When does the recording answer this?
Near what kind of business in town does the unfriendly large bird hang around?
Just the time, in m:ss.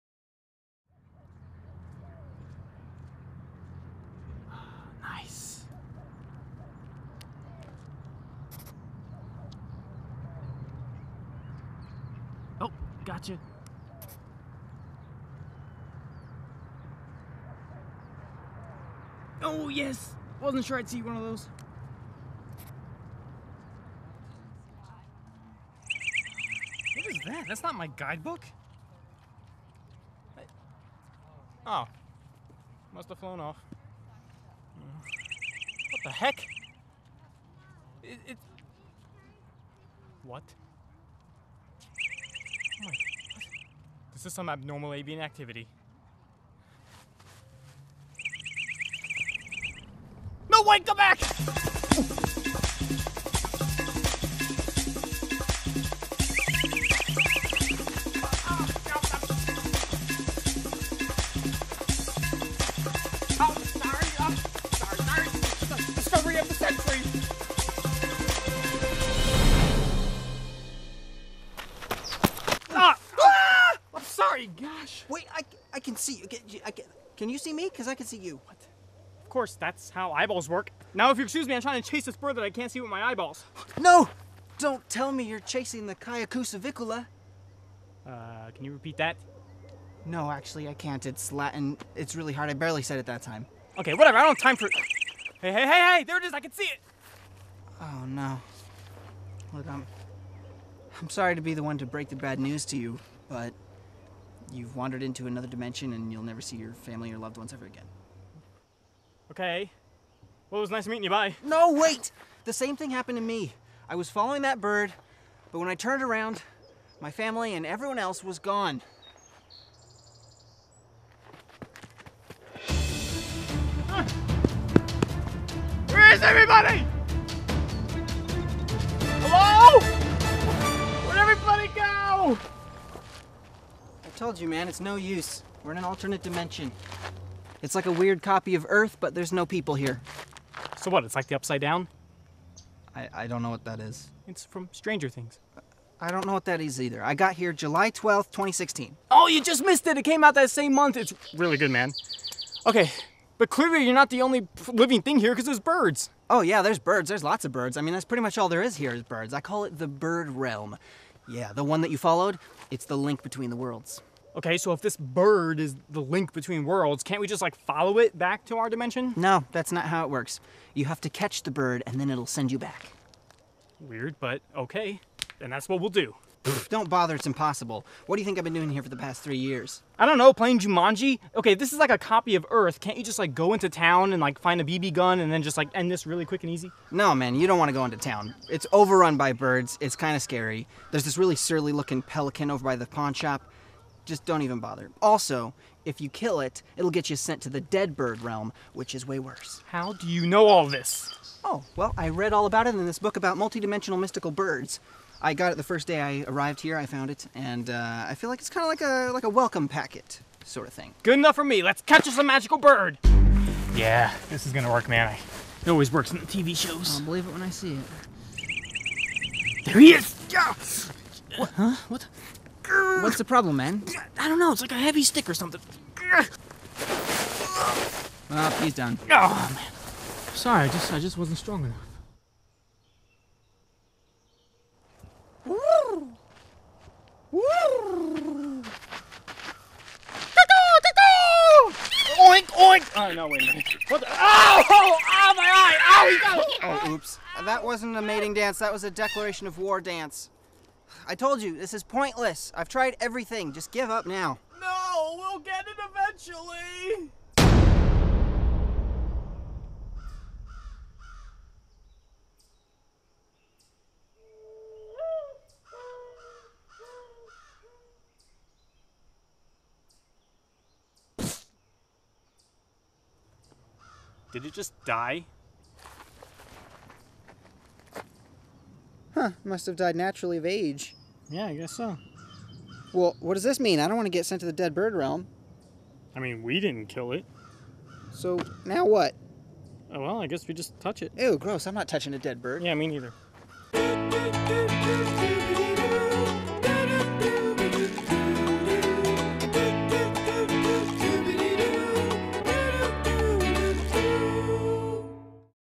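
3:12.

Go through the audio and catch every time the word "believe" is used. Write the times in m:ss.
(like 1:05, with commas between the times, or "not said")
3:37.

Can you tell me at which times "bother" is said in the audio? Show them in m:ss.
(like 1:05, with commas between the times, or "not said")
2:56, 3:14.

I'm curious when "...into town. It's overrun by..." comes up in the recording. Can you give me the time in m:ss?
3:07.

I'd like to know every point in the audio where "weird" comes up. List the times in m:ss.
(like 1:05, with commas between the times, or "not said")
2:17, 2:53.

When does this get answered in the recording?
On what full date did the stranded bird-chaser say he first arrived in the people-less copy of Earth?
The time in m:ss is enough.
2:27.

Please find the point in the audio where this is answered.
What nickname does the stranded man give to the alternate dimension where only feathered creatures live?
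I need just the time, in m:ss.
2:39.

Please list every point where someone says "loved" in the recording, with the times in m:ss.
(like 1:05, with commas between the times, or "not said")
1:47.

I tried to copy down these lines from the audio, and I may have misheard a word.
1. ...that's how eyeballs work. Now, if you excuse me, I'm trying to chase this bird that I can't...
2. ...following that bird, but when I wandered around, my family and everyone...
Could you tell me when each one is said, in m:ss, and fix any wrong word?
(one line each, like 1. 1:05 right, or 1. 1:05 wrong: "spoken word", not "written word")
1. 1:19 right
2. 1:54 wrong: "turned", not "wandered".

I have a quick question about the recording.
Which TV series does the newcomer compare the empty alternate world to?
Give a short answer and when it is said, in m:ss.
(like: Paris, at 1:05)
Stranger Things, at 2:24.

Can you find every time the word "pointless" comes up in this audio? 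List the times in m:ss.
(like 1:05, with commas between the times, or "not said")
4:11.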